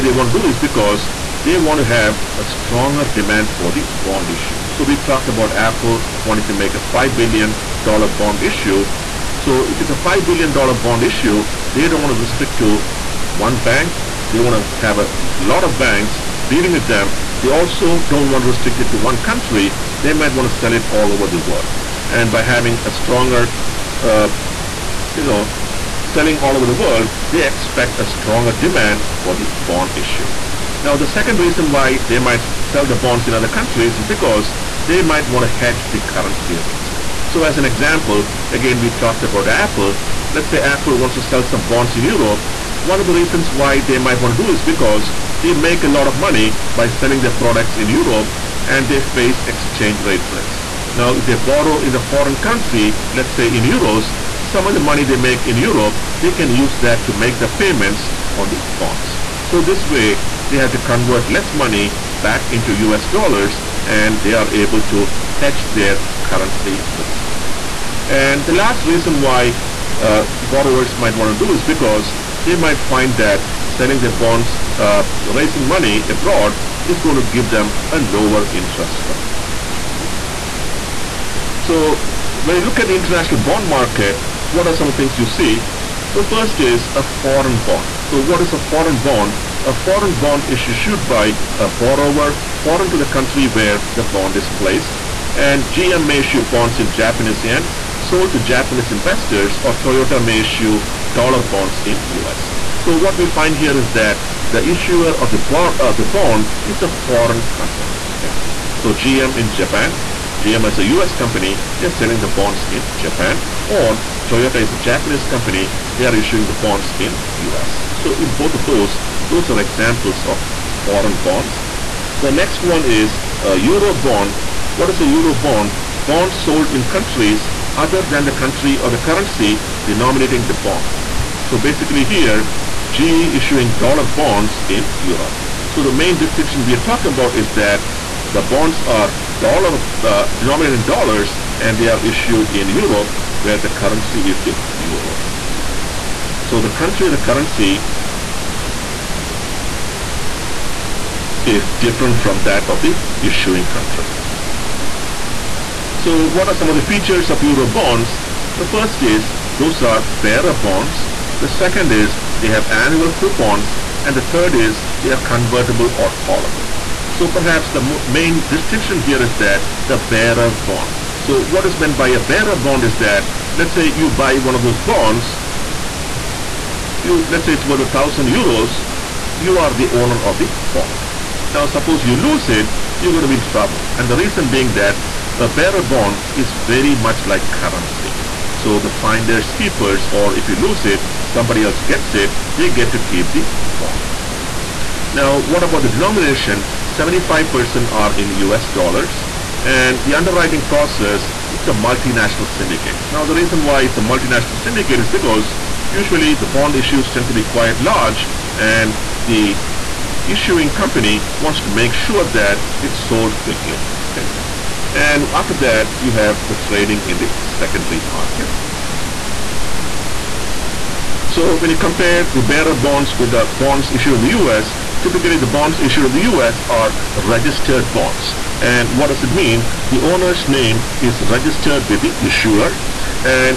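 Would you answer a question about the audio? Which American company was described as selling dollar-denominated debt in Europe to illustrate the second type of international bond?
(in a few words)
GE.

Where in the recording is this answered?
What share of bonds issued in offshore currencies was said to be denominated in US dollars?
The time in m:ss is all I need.
3:16.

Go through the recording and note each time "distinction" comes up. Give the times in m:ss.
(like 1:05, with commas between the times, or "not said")
2:16, 2:48.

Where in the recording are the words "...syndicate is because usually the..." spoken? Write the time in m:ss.
3:24.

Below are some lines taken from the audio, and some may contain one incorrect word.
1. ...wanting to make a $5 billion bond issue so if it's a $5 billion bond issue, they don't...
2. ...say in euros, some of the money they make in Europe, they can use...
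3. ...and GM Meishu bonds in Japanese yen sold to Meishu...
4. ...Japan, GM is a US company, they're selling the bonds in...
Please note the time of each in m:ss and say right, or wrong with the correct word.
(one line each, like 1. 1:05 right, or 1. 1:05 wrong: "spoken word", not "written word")
1. 0:06 right
2. 0:53 right
3. 1:35 wrong: "Japanese", not "Meishu"
4. 1:49 right.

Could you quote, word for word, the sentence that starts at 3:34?
And after that, you have the trading in the secondary market.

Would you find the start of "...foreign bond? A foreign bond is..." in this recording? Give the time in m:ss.
1:28.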